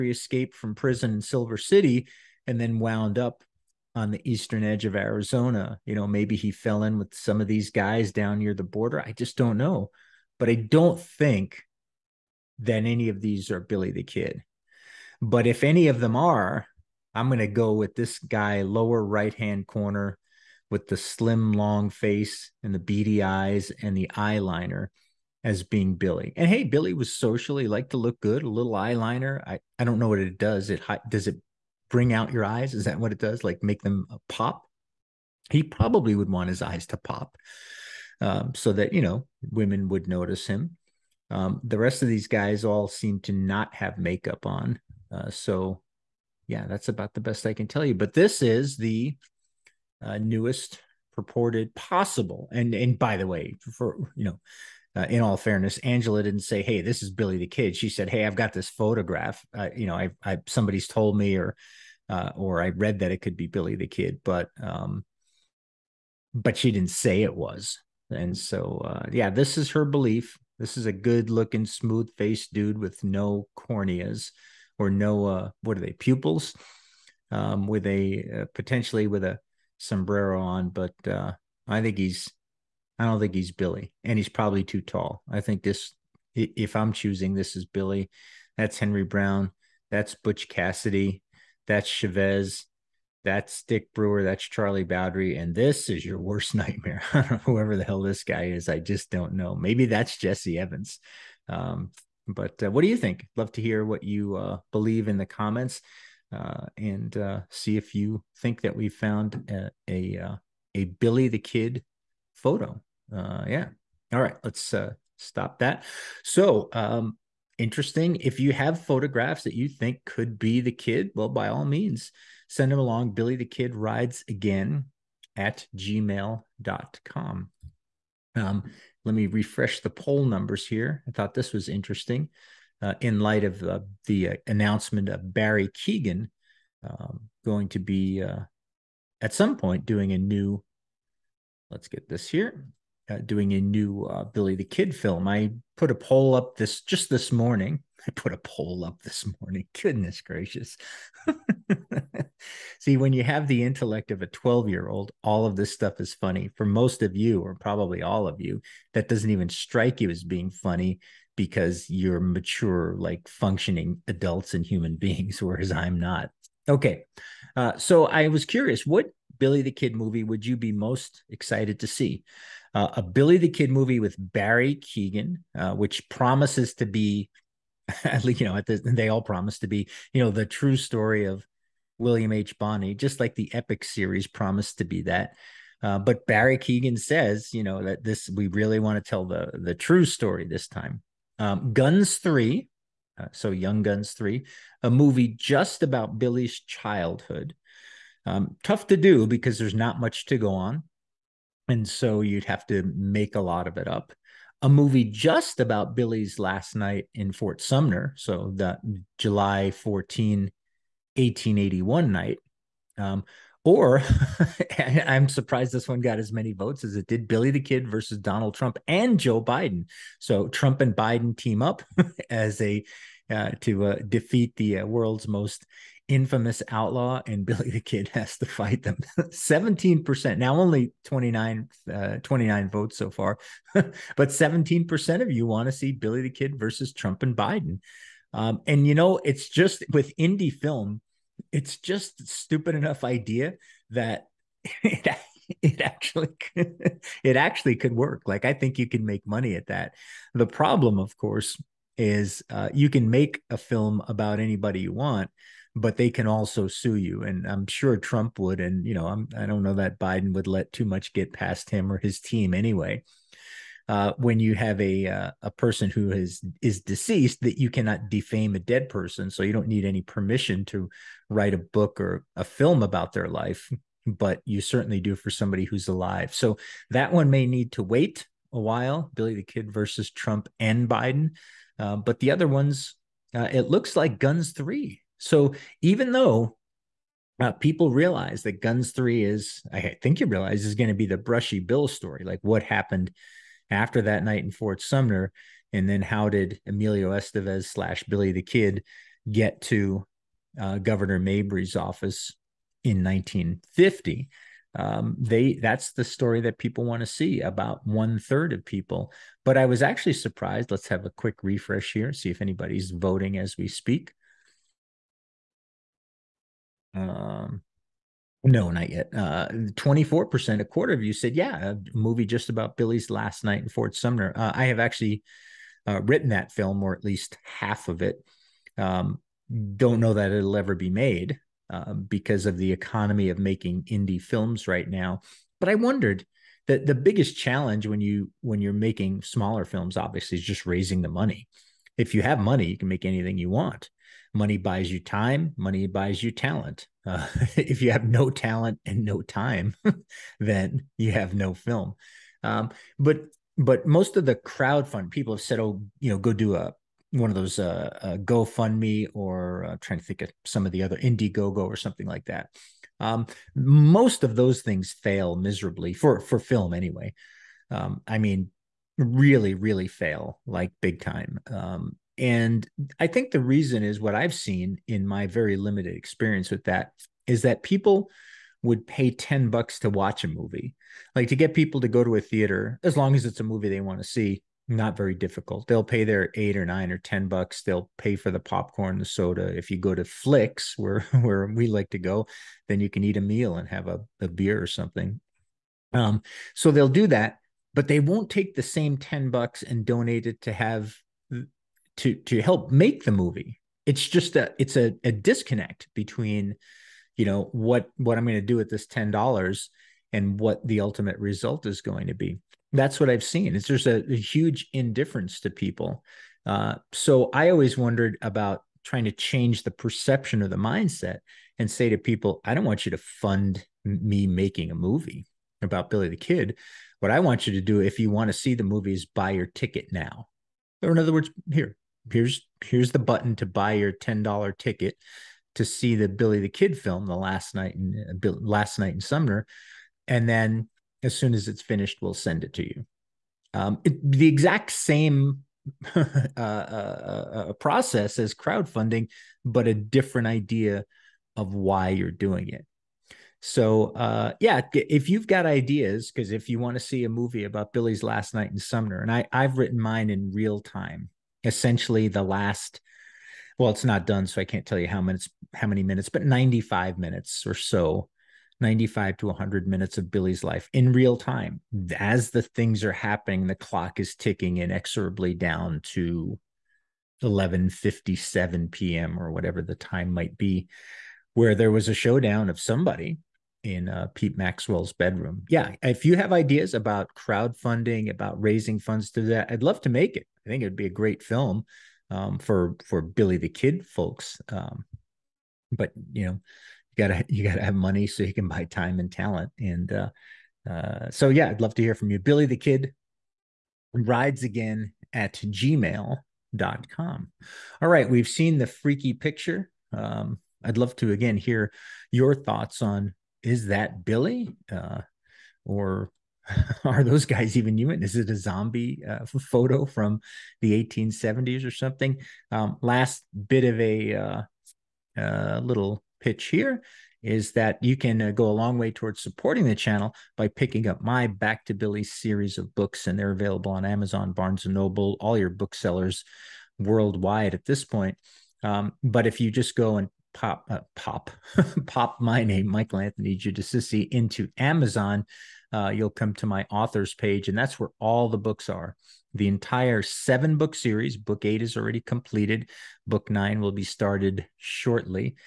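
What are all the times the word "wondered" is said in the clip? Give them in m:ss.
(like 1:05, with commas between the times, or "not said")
5:35, 6:57.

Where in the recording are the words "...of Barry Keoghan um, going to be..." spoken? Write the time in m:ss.
2:15.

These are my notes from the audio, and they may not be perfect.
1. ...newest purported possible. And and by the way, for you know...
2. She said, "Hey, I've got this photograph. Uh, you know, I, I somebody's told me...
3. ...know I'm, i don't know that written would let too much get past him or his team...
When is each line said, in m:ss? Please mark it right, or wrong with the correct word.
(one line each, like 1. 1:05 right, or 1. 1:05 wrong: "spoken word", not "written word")
1. 0:50 right
2. 0:57 right
3. 4:18 wrong: "biden", not "written".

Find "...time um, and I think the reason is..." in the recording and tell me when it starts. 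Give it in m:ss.
6:11.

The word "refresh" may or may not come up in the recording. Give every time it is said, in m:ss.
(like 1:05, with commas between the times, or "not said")
2:09, 5:11.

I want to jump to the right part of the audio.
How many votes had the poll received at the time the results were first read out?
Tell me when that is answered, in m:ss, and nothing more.
3:52.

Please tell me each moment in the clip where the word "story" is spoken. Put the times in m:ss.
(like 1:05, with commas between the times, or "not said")
3:00, 3:10, 4:51, 5:06.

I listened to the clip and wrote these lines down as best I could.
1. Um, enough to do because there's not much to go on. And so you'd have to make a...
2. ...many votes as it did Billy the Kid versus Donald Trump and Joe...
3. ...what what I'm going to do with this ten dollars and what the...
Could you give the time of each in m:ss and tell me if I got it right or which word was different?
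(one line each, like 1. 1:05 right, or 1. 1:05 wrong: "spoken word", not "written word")
1. 3:18 wrong: "tough", not "enough"
2. 3:36 right
3. 6:47 right.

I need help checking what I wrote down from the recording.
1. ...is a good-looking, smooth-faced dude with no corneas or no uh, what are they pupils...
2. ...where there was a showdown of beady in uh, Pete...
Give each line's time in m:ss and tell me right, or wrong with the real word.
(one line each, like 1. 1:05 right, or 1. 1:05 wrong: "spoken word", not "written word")
1. 1:10 right
2. 8:01 wrong: "somebody", not "beady".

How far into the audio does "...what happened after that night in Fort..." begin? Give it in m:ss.
4:52.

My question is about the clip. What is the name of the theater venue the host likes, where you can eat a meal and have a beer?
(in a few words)
Flicks.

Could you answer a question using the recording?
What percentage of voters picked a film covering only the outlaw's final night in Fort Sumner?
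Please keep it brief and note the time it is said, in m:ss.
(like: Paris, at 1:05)
24%, at 5:19.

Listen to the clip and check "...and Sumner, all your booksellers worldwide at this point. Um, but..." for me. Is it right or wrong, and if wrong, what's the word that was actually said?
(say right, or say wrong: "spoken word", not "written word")
wrong: "Noble", not "Sumner".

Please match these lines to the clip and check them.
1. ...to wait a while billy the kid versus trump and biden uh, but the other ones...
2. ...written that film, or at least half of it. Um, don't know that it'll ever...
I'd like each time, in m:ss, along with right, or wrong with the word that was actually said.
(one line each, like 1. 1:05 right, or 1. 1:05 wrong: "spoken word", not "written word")
1. 4:37 right
2. 5:26 right.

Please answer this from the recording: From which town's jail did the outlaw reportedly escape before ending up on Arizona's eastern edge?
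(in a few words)
Silver City.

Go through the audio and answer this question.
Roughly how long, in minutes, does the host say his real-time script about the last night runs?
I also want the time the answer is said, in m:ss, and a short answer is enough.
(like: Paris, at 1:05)
95 minutes, at 7:46.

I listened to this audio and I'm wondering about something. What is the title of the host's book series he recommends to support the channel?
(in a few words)
Back to Billy.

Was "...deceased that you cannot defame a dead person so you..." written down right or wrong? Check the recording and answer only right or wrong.
right.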